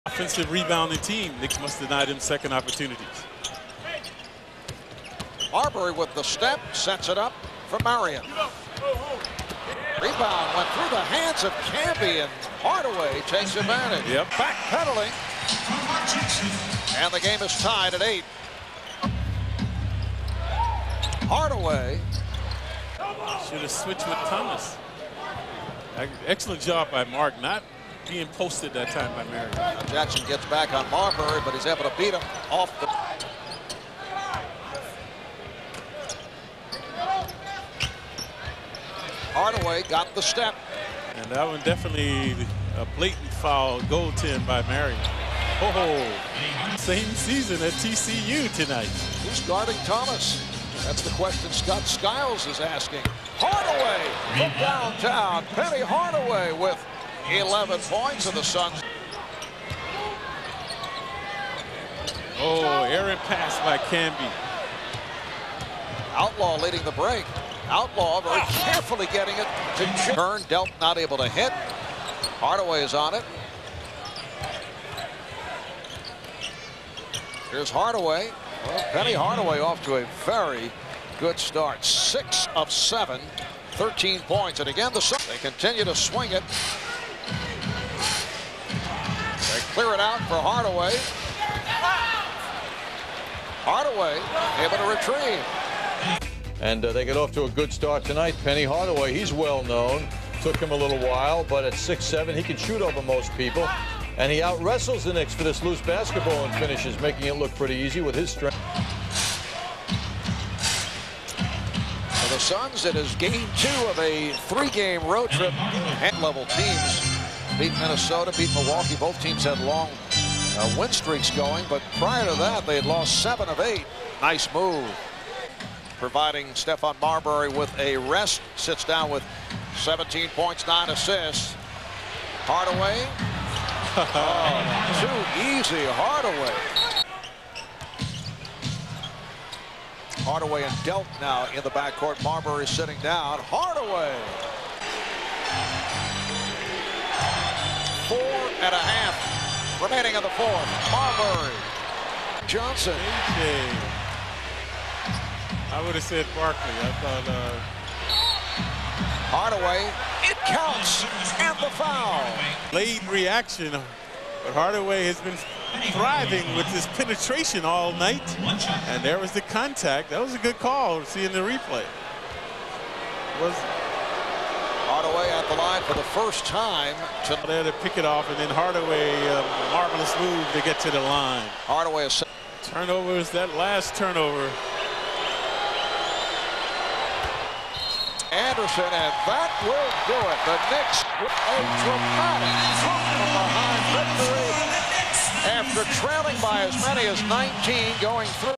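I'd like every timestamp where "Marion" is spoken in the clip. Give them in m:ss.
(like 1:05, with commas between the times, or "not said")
0:07, 0:29, 0:44.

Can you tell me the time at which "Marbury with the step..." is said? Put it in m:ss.
0:05.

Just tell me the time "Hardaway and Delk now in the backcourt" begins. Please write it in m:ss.
2:20.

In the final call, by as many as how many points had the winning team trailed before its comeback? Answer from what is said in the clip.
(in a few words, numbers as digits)
19.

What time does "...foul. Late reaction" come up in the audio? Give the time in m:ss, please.
2:41.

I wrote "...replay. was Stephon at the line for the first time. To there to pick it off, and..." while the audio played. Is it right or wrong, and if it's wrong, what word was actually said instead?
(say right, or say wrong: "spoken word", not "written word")
wrong: "Hardaway", not "Stephon".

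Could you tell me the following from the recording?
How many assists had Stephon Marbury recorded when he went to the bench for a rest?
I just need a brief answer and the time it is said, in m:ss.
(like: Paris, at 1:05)
9, at 2:10.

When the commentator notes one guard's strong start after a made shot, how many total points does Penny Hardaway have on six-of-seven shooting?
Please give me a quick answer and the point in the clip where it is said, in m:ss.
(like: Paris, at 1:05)
13, at 1:23.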